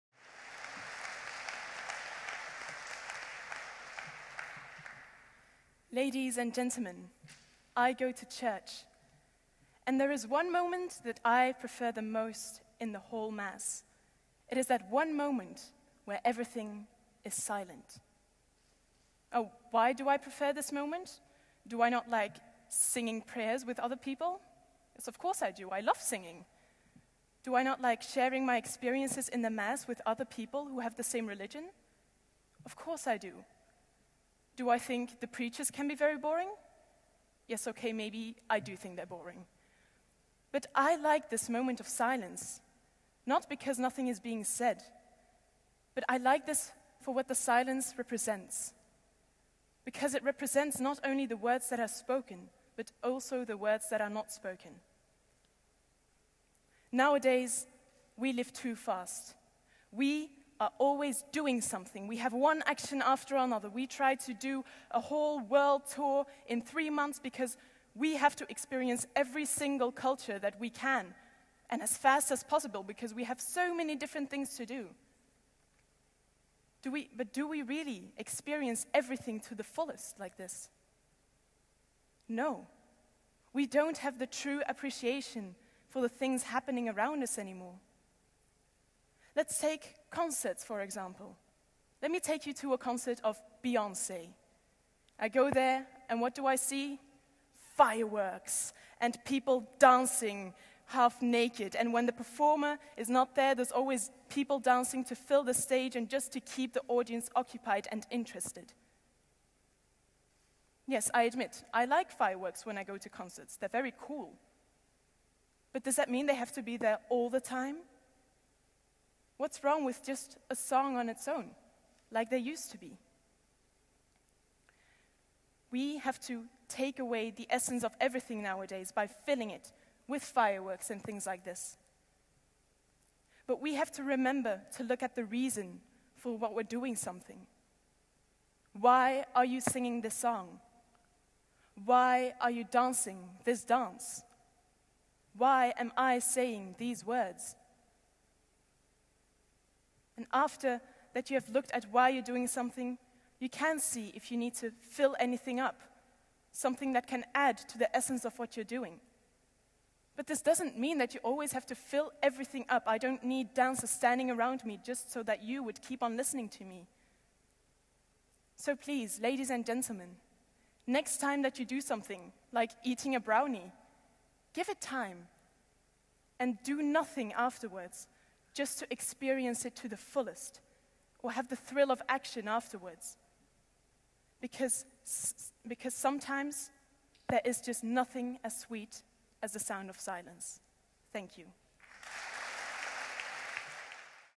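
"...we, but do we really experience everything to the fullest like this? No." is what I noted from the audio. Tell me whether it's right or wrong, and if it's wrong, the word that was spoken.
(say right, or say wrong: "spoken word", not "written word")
right.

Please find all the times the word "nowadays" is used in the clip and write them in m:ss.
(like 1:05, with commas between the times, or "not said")
0:56, 2:08.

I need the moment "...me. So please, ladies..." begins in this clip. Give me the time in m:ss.
2:46.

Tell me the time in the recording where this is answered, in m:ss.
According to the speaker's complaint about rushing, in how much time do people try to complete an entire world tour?
1:06.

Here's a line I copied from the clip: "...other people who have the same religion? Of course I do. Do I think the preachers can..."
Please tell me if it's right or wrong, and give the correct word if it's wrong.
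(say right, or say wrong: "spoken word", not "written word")
right.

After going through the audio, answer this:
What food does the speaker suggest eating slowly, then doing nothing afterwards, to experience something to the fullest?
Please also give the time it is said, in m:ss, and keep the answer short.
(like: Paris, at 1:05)
brownie, at 2:53.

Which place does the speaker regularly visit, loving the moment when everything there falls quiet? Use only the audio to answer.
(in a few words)
church.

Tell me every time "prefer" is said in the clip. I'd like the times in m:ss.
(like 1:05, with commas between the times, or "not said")
0:11, 0:20.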